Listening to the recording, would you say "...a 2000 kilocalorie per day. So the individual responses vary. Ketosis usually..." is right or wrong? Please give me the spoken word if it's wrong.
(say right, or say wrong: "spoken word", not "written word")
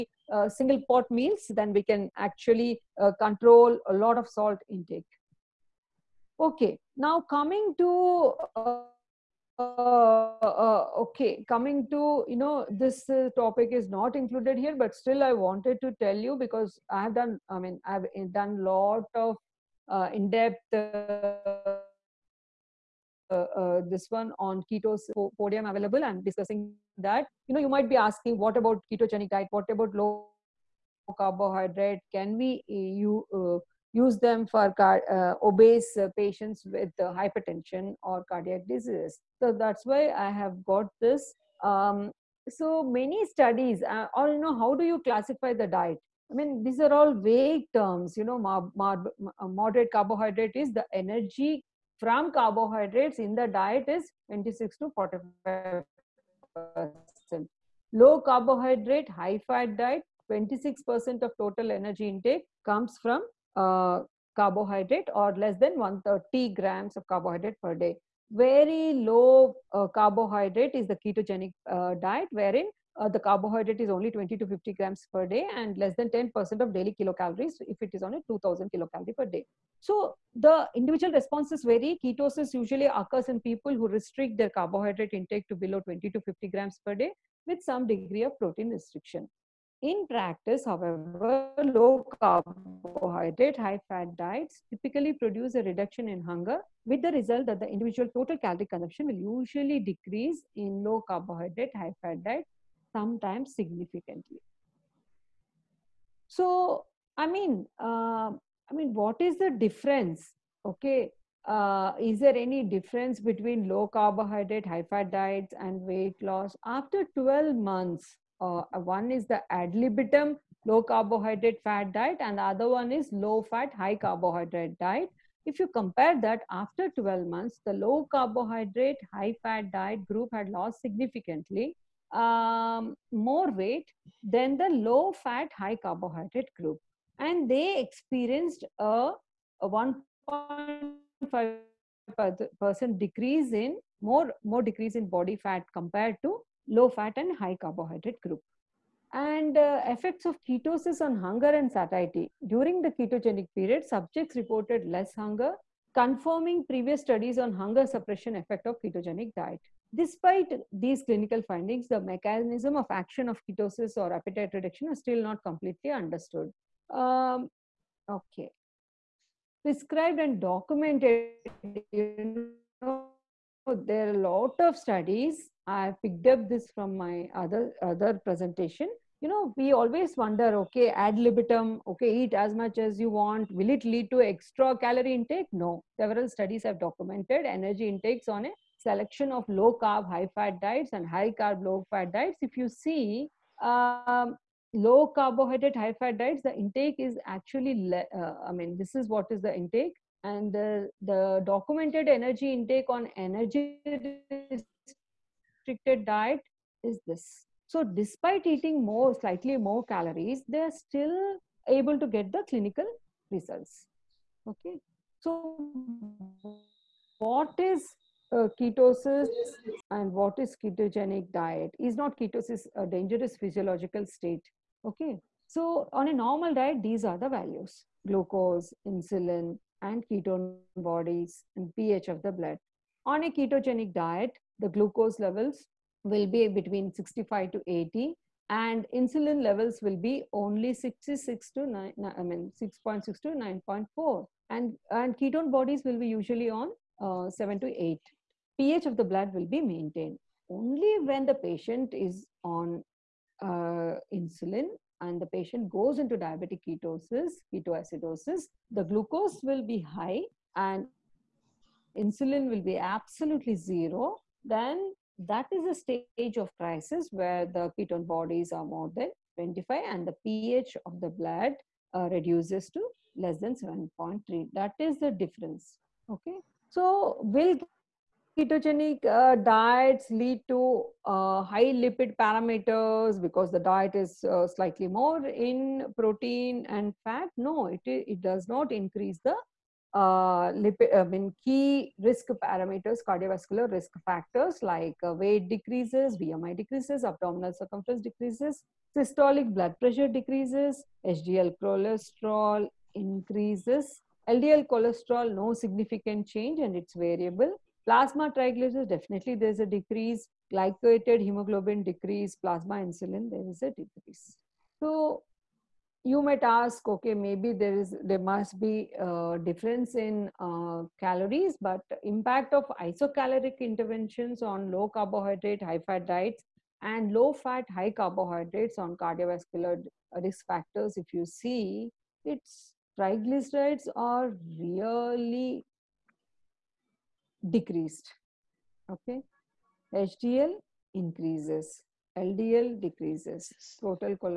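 right.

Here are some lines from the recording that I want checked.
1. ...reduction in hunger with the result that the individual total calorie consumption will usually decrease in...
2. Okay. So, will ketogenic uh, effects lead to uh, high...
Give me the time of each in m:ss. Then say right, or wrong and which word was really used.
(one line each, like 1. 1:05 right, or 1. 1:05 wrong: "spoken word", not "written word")
1. 1:35 right
2. 4:36 wrong: "diets", not "effects".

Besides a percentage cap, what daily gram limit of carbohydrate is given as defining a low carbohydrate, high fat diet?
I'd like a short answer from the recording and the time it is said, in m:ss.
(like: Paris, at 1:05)
less than 130 grams, at 1:05.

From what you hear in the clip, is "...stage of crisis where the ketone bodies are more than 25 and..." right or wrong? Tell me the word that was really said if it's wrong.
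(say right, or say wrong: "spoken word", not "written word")
right.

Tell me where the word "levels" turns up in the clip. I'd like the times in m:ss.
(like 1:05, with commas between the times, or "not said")
3:55, 3:59.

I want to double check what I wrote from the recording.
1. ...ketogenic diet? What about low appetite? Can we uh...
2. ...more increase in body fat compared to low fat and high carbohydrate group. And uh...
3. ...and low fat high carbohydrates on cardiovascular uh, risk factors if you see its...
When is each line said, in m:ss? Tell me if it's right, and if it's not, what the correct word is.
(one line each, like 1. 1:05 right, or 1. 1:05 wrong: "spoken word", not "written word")
1. 0:28 wrong: "carbohydrate", not "appetite"
2. 2:24 wrong: "decrease", not "increase"
3. 5:26 right.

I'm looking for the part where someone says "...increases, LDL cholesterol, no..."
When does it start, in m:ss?
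5:02.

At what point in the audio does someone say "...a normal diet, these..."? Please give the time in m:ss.
3:46.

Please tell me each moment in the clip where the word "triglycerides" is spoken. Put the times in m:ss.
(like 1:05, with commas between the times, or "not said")
5:08, 5:32.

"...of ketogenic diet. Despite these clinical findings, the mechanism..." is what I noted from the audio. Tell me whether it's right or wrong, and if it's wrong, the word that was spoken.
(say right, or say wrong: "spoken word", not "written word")
right.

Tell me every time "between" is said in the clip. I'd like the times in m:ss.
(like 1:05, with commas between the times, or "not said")
1:53, 3:56.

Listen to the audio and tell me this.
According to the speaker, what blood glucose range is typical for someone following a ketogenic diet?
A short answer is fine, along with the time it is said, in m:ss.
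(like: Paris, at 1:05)
65 to 80, at 3:56.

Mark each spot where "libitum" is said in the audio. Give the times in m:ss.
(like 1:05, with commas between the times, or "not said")
1:59, 3:01.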